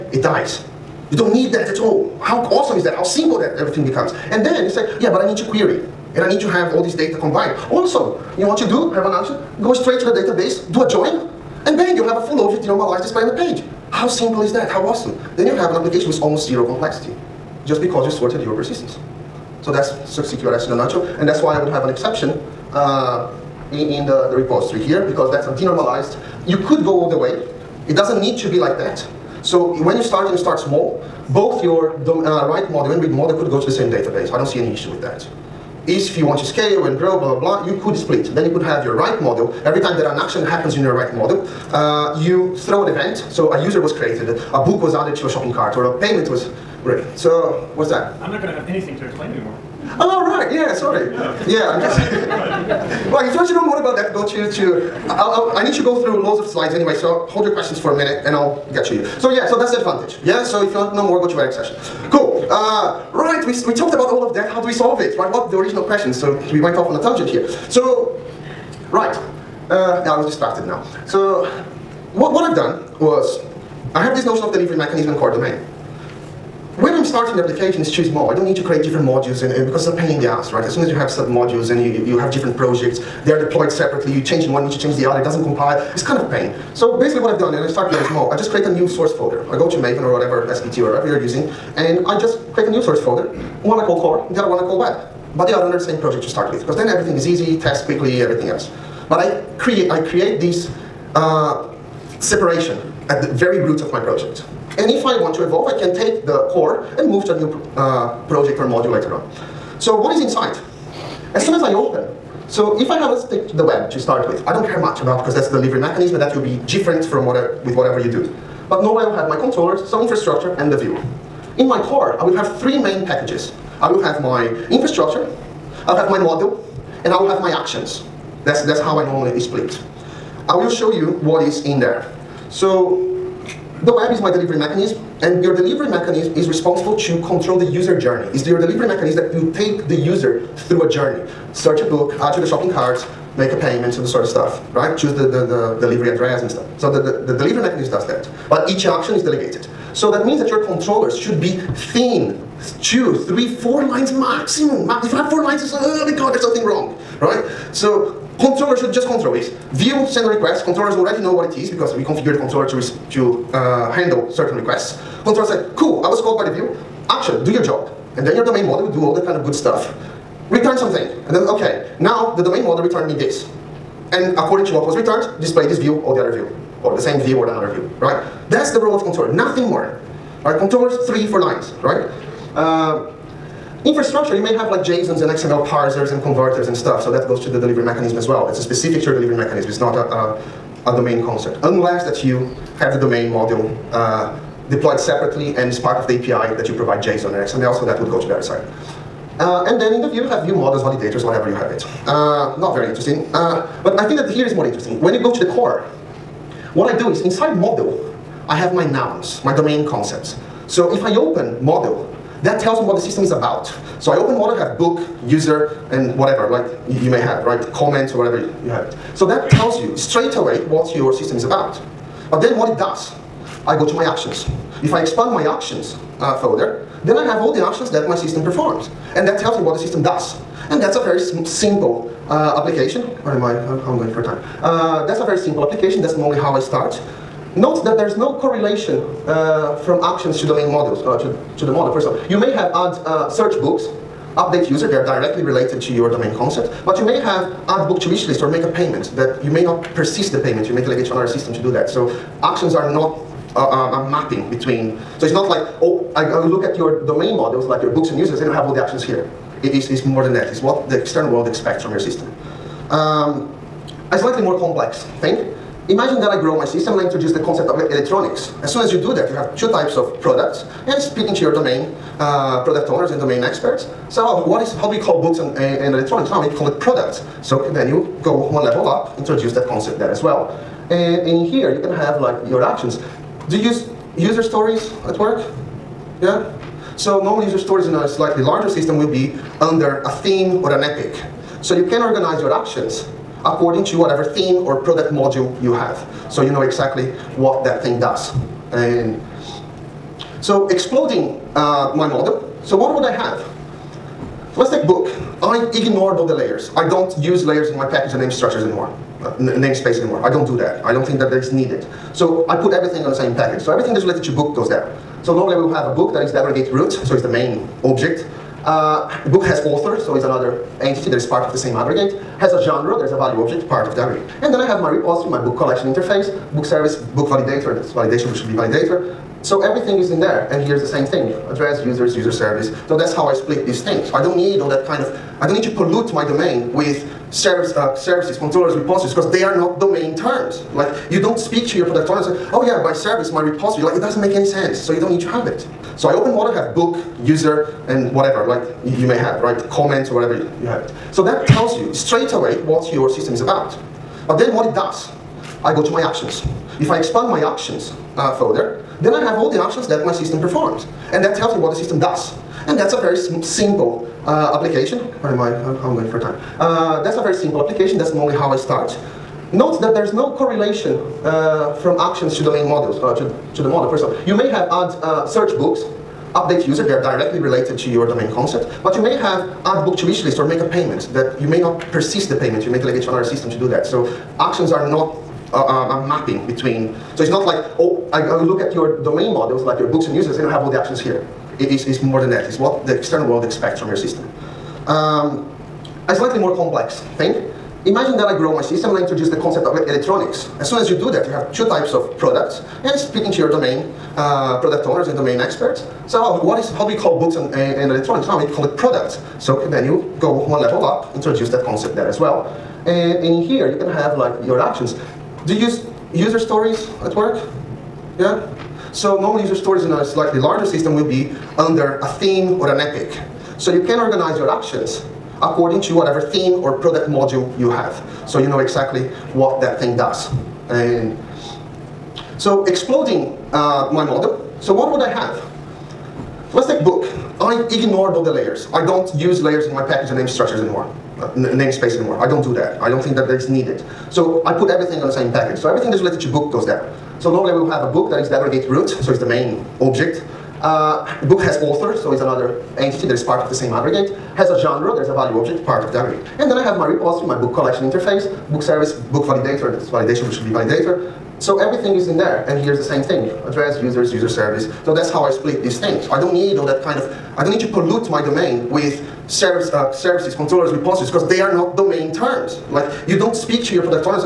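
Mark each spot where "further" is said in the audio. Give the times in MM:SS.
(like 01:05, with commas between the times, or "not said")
03:46.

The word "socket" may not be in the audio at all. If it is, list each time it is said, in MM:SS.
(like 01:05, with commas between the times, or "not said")
not said.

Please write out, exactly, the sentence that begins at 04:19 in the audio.
It is it's more than that, it's what the external world expects from your system.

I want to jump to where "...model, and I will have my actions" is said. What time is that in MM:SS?
02:06.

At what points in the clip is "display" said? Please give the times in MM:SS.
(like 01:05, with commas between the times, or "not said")
00:13, 02:55.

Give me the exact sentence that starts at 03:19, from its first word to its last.
Uh, and then in the view, you have view models, validators, whatever you have it.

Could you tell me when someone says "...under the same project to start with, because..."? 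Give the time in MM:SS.
01:35.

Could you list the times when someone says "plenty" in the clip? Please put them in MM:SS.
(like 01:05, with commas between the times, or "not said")
not said.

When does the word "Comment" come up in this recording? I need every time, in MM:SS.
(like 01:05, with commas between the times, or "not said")
03:37, 05:49.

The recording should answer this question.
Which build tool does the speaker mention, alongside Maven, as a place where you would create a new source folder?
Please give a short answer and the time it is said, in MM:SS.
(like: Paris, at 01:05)
SBT, at 01:30.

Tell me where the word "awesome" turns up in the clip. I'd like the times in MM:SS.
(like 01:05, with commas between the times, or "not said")
00:02, 00:14.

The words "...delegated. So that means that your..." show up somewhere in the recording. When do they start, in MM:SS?
02:29.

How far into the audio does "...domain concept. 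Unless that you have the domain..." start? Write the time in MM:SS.
03:10.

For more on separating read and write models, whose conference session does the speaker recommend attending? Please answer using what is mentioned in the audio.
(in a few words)
Eric's.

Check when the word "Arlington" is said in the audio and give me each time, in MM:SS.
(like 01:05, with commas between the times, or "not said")
not said.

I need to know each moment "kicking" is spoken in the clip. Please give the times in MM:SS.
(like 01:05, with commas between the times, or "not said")
not said.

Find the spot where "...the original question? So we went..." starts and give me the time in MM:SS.
01:05.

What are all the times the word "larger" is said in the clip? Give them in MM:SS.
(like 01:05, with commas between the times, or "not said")
04:48, 07:00.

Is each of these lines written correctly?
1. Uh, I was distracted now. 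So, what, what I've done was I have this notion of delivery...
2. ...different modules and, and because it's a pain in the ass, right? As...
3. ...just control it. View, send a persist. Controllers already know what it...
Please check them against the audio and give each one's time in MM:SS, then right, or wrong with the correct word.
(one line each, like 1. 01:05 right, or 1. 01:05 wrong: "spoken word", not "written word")
1. 01:09 right
2. 01:18 right
3. 02:38 wrong: "request", not "persist".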